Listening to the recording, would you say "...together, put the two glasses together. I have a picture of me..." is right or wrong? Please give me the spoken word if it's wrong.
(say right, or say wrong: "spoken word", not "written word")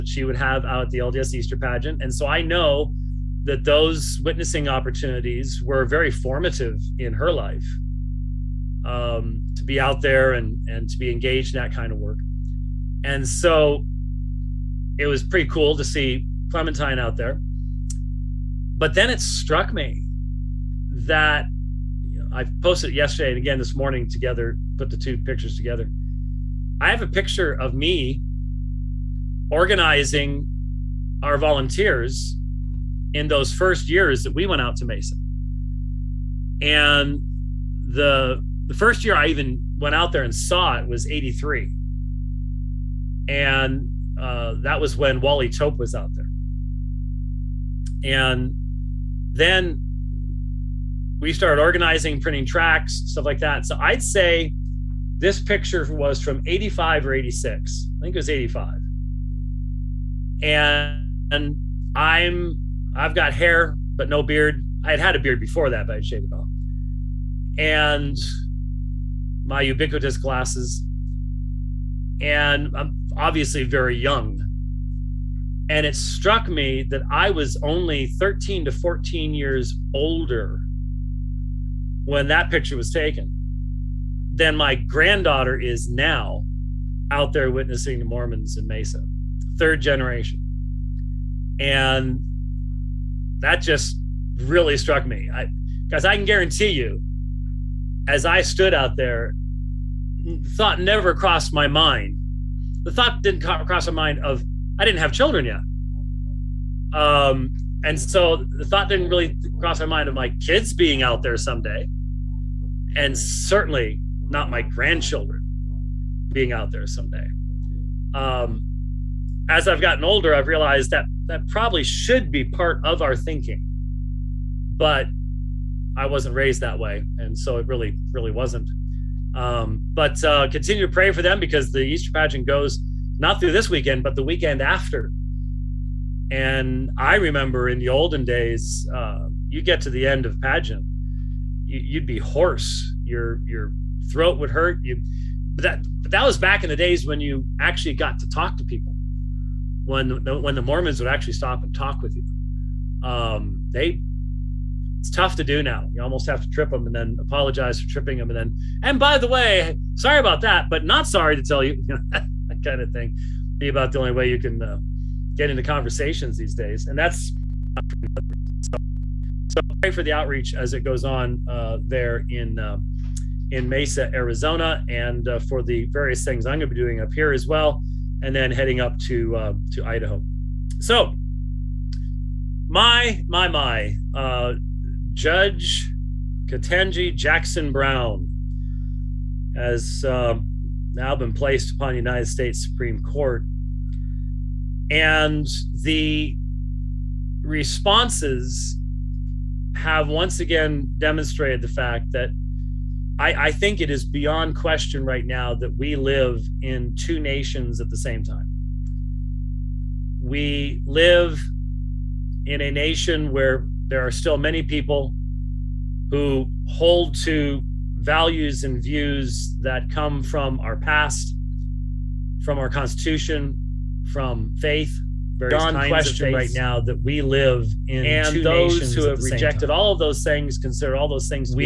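wrong: "pictures", not "glasses".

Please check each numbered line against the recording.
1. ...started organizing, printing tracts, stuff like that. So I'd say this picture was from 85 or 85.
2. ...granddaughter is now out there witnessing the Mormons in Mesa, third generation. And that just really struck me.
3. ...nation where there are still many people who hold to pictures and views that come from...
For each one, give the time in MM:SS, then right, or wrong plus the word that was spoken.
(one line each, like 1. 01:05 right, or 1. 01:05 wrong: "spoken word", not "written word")
1. 00:51 wrong: "86", not "85"
2. 01:24 right
3. 03:32 wrong: "values", not "pictures".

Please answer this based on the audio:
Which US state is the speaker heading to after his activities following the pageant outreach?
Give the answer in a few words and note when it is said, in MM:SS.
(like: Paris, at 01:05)
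Idaho, at 02:59.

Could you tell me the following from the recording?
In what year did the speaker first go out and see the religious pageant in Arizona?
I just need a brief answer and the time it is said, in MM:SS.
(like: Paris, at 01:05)
1983, at 00:41.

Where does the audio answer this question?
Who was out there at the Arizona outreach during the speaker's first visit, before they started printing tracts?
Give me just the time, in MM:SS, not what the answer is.
00:45.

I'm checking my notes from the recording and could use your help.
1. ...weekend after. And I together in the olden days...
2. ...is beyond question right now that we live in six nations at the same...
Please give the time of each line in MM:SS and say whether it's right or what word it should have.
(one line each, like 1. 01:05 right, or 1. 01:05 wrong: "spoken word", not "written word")
1. 02:14 wrong: "remember", not "together"
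2. 03:23 wrong: "two", not "six".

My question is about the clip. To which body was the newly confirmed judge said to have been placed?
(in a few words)
United States Supreme Court.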